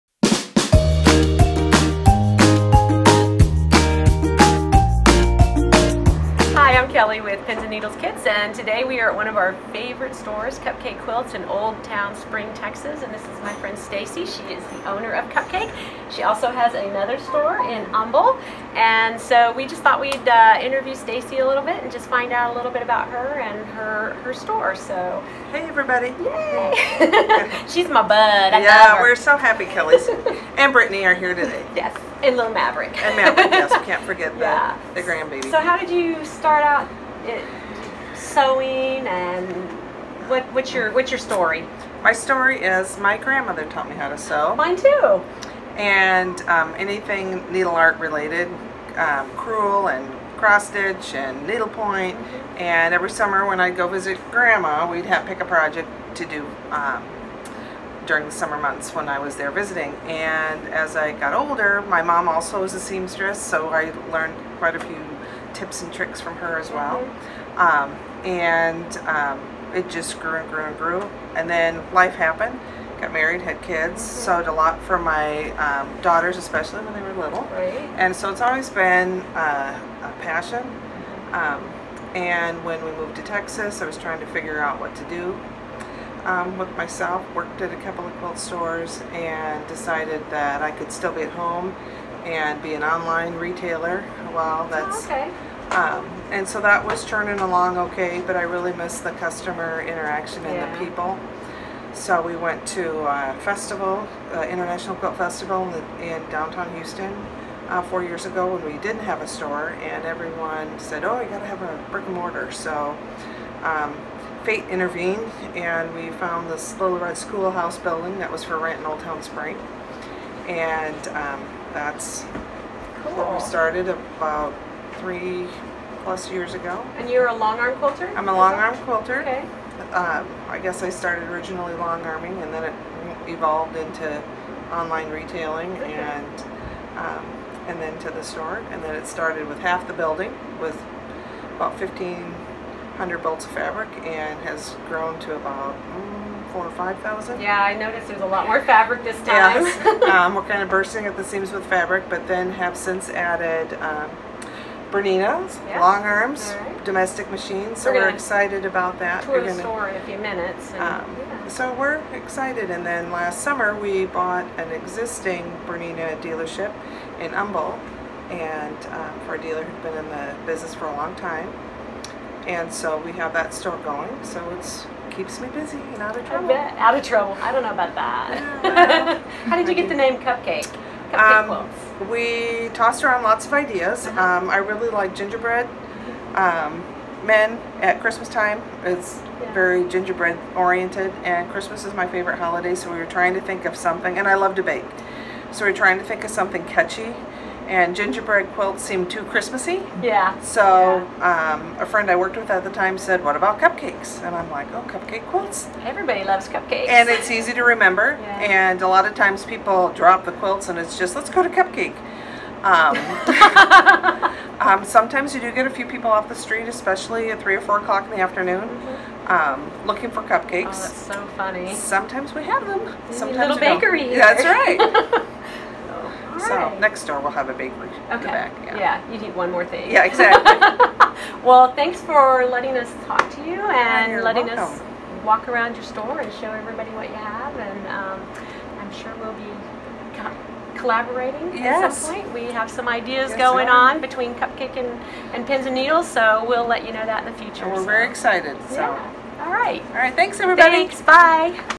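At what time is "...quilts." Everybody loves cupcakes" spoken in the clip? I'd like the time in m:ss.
3:25.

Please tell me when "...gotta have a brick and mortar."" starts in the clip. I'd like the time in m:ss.
1:51.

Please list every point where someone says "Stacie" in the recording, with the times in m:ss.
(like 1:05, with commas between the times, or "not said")
0:13, 0:20.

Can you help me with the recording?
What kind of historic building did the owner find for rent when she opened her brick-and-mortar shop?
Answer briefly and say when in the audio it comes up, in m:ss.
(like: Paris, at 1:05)
little red schoolhouse, at 1:56.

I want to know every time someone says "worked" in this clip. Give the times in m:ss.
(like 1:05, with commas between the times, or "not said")
1:27, 3:22.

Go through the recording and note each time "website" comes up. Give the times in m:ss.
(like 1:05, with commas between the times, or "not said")
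not said.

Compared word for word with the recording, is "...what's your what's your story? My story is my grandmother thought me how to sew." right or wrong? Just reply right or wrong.
wrong.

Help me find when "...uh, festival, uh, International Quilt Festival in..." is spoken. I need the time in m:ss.
1:43.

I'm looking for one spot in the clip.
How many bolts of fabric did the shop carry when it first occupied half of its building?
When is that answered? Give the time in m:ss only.
2:21.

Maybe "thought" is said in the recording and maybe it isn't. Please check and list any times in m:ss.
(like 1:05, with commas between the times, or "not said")
0:19.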